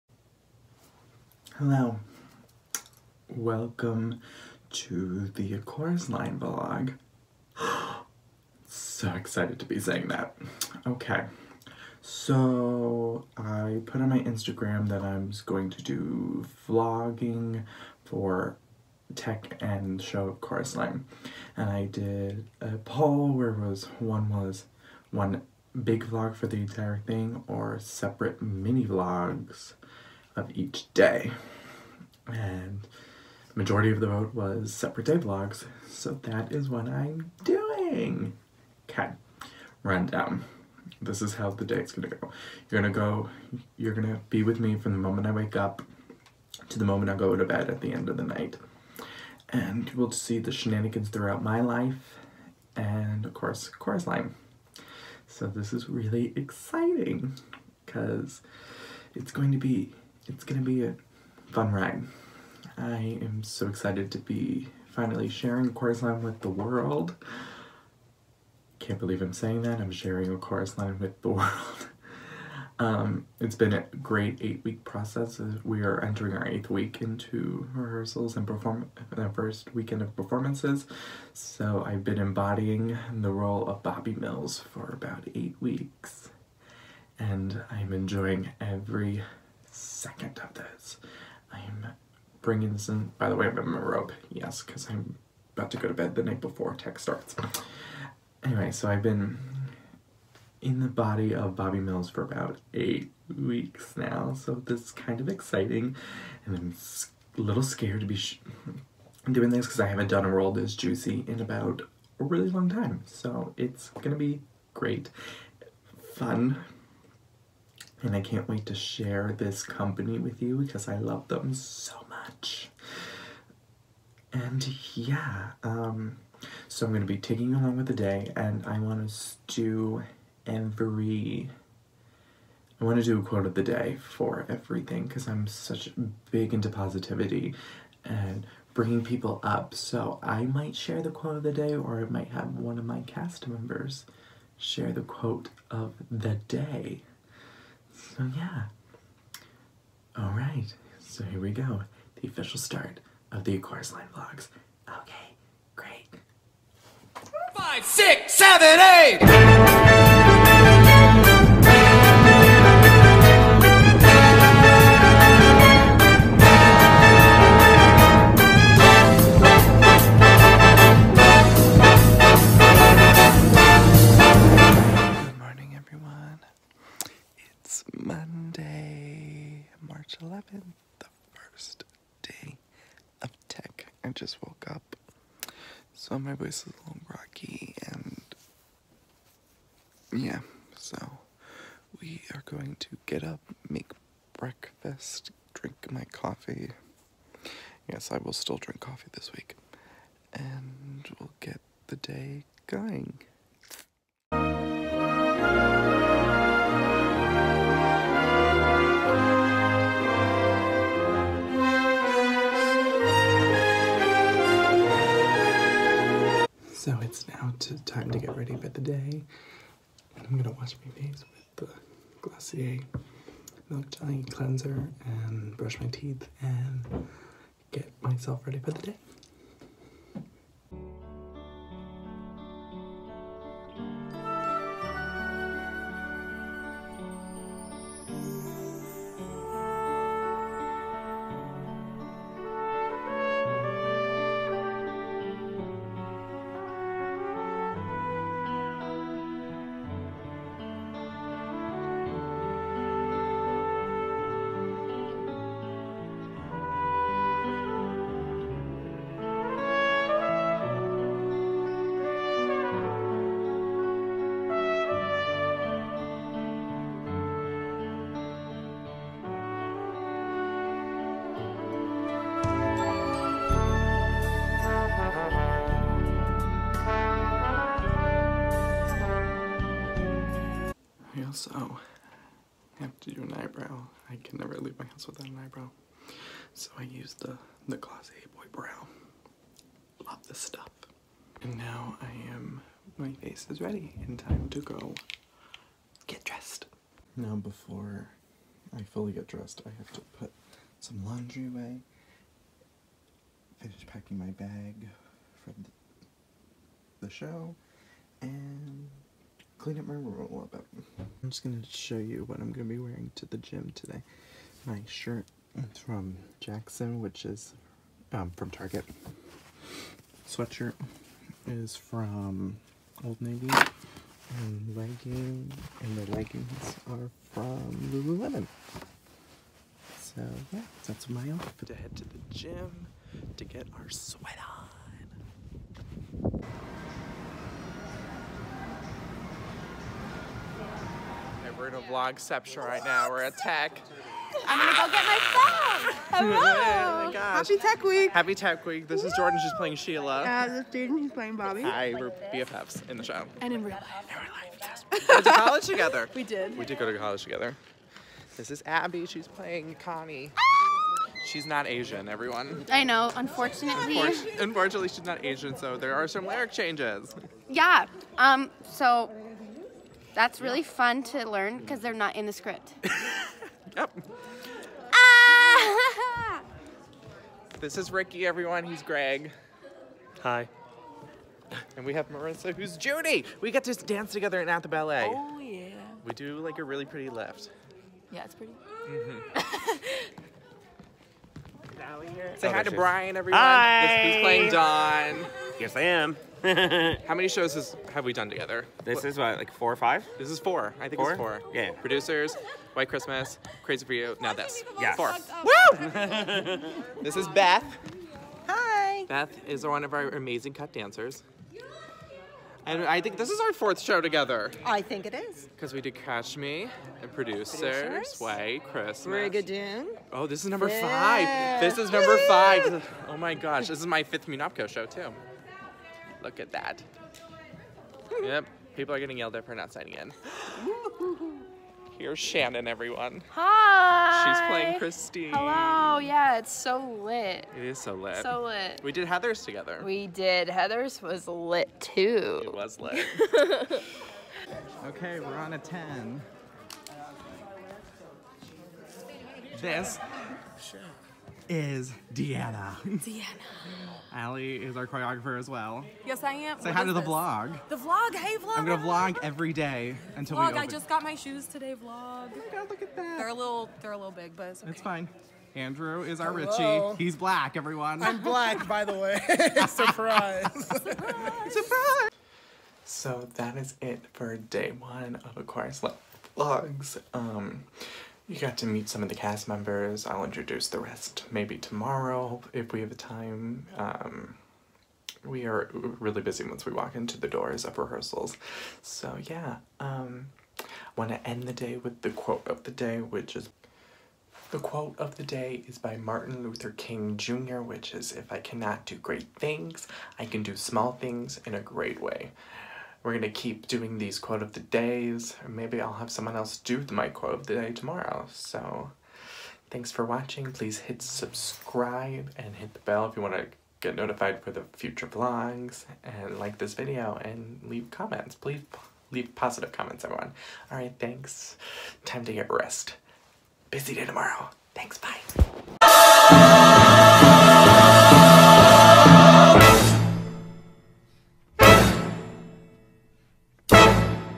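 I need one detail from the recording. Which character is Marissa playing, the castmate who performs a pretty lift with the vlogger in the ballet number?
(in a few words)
Judy.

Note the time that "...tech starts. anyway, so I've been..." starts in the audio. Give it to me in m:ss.
1:36.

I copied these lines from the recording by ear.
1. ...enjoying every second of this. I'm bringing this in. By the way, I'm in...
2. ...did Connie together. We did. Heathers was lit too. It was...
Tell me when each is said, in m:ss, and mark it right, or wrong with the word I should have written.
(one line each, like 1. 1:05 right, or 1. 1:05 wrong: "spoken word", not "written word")
1. 1:27 right
2. 7:18 wrong: "Heathers", not "Connie".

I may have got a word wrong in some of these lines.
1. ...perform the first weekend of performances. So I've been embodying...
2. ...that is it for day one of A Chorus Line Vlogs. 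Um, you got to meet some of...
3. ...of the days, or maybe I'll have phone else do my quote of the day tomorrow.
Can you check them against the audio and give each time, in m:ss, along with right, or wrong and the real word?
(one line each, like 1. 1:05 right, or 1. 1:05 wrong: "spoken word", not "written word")
1. 1:18 right
2. 7:53 right
3. 8:24 wrong: "someone", not "phone".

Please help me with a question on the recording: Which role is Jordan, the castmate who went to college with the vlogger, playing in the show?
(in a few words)
Sheila.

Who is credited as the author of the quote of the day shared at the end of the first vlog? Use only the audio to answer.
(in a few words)
Martin Luther King Jr.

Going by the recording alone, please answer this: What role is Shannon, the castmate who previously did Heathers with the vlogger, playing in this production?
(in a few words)
Christine.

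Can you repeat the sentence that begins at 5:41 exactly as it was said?
we're in a vlogception right now.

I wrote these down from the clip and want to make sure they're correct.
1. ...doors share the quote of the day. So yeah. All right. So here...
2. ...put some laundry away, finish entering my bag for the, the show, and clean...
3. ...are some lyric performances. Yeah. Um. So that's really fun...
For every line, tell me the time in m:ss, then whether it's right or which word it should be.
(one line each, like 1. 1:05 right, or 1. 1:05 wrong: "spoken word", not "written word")
1. 2:23 wrong: "members", not "doors"
2. 5:00 wrong: "packing", not "entering"
3. 6:05 wrong: "changes", not "performances".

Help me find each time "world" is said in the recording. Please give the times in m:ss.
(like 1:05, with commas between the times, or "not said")
1:06, 1:11, 1:50.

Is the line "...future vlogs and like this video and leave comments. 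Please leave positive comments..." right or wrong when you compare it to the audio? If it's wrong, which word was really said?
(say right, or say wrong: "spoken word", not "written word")
right.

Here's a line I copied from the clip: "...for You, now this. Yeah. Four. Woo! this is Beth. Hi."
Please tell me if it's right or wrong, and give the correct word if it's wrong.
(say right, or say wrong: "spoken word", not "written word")
right.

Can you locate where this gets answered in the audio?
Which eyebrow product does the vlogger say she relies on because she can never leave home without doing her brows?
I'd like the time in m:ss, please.
4:47.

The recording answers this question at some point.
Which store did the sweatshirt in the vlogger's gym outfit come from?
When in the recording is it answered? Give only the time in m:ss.
5:23.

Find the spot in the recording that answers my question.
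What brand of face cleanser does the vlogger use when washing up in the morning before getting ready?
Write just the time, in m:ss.
3:42.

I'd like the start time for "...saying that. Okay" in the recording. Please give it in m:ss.
0:09.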